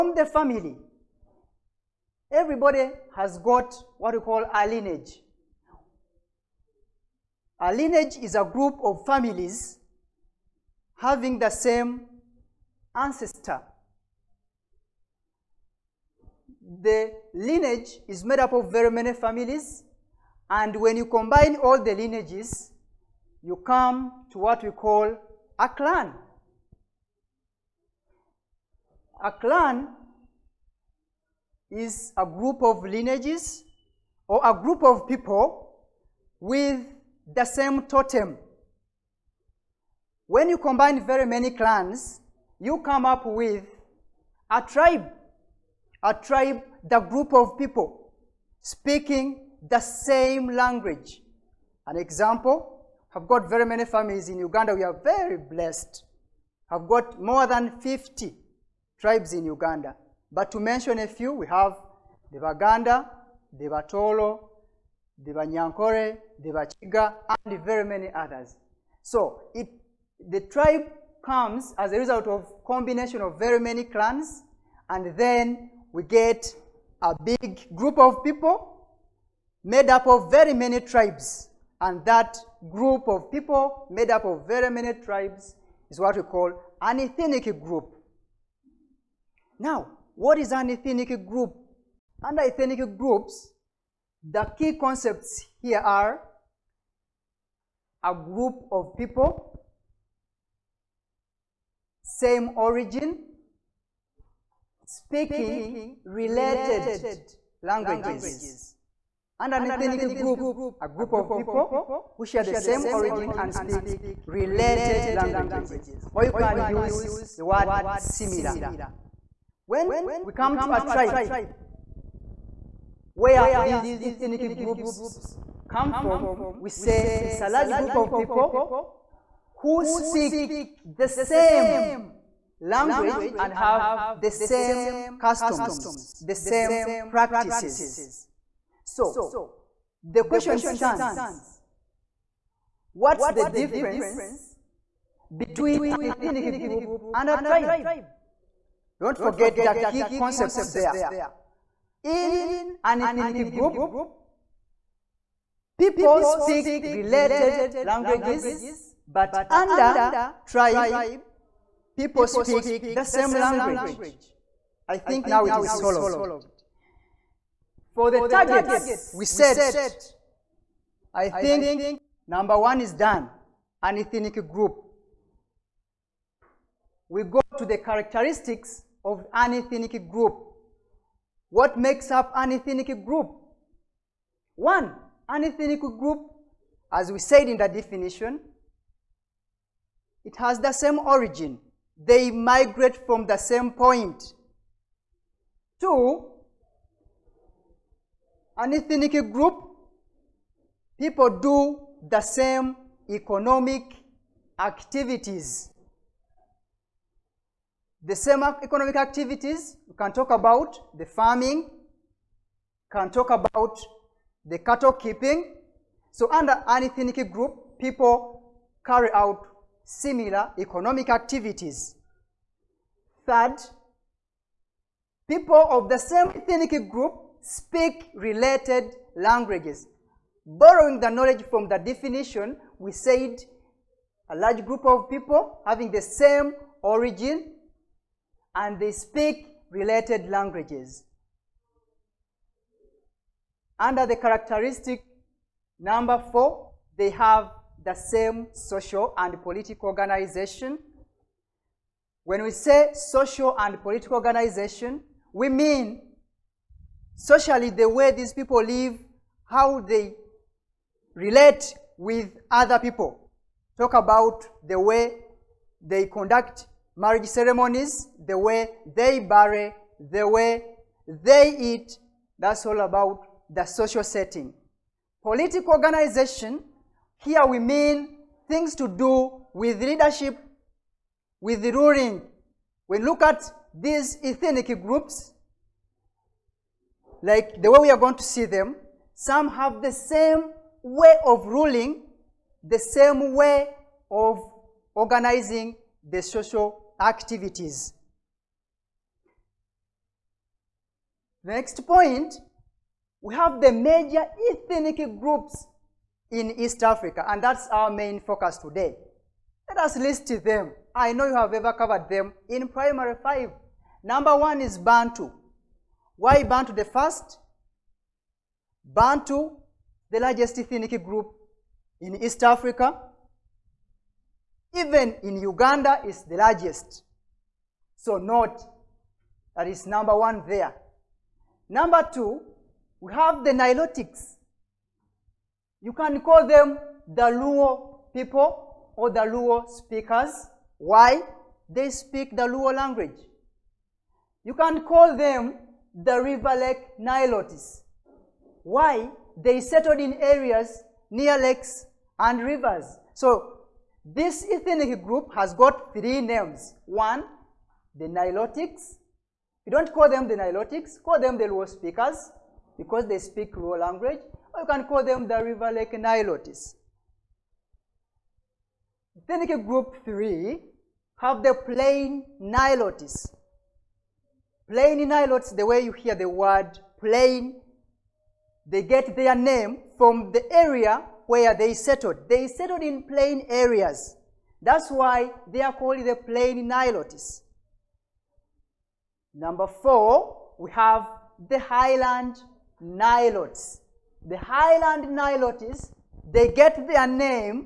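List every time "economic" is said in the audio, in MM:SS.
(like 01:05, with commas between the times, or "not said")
03:23, 03:28, 03:40.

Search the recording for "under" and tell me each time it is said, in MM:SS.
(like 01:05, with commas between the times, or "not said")
01:32, 02:39, 03:36, 04:03.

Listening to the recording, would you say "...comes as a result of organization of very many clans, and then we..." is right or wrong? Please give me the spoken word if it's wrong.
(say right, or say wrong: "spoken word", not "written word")
wrong: "combination", not "organization".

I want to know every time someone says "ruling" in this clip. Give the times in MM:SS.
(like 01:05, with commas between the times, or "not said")
04:41, 04:51.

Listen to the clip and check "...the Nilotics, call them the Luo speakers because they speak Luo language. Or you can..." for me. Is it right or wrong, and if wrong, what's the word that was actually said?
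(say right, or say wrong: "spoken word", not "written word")
right.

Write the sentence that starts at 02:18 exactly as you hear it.
So the question stands, what's the difference between an ethnic group and a tribe?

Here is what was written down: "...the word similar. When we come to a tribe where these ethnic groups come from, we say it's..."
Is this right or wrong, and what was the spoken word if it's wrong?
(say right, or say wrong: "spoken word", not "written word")
right.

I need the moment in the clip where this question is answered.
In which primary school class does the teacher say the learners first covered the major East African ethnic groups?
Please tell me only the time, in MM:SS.
05:12.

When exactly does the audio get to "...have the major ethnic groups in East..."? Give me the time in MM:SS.
05:03.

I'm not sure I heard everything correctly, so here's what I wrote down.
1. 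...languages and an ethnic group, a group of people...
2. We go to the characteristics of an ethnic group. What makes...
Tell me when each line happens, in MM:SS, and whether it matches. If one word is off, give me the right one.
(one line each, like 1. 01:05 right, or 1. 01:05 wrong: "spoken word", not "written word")
1. 01:47 right
2. 02:57 right.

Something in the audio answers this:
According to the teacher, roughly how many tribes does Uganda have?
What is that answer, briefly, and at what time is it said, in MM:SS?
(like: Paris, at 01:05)
More than 50, at 00:57.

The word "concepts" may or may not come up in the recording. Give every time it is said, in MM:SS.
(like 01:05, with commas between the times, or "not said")
01:34, 02:30.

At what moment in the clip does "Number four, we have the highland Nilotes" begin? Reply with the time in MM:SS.
06:29.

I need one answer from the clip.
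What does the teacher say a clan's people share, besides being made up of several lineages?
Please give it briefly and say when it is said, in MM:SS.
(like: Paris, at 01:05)
The same totem, at 00:37.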